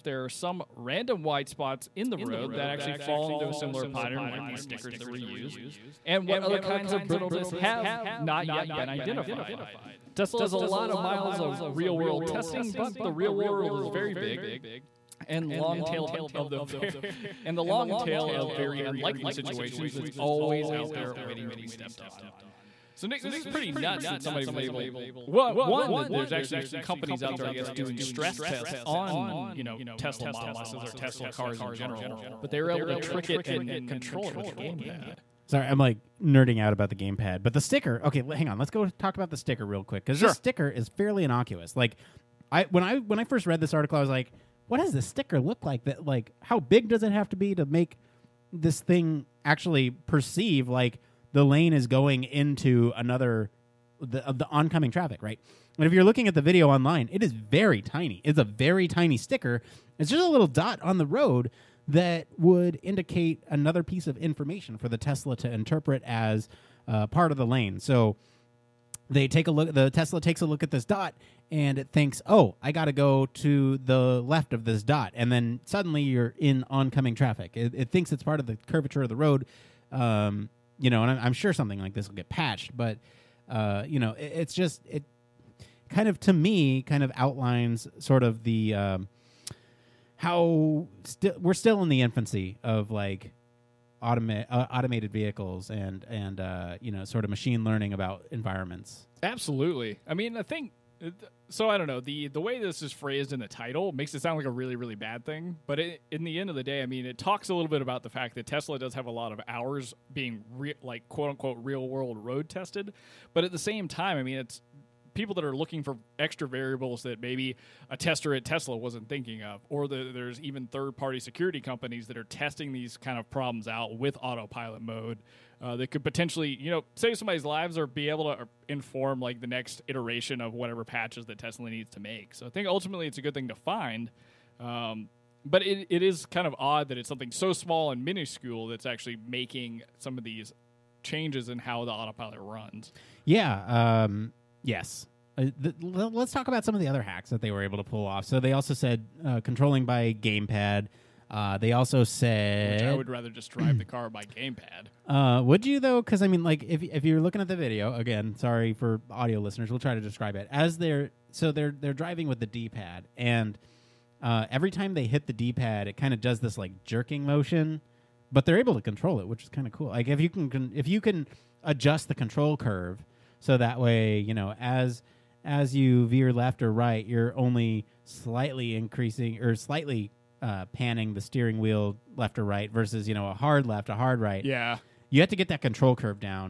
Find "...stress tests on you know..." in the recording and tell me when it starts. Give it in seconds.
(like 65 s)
28 s.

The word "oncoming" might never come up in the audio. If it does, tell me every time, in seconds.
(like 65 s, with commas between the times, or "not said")
54 s, 76 s.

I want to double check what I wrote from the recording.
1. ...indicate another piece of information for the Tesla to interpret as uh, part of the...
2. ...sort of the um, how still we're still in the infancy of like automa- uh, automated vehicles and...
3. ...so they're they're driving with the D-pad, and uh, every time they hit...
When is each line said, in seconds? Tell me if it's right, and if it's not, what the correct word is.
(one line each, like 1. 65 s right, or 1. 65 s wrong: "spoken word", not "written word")
1. 62 s right
2. 87 s right
3. 161 s right.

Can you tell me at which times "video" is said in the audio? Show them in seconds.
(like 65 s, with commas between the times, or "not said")
56 s, 157 s.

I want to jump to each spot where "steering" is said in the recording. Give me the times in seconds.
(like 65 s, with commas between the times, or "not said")
181 s.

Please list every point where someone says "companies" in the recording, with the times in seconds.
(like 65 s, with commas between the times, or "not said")
26 s, 121 s.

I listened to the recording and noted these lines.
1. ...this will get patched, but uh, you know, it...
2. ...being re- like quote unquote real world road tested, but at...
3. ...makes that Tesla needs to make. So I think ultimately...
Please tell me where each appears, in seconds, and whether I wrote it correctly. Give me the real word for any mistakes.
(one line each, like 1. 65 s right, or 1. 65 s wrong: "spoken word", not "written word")
1. 81 s right
2. 110 s right
3. 130 s wrong: "patches", not "makes".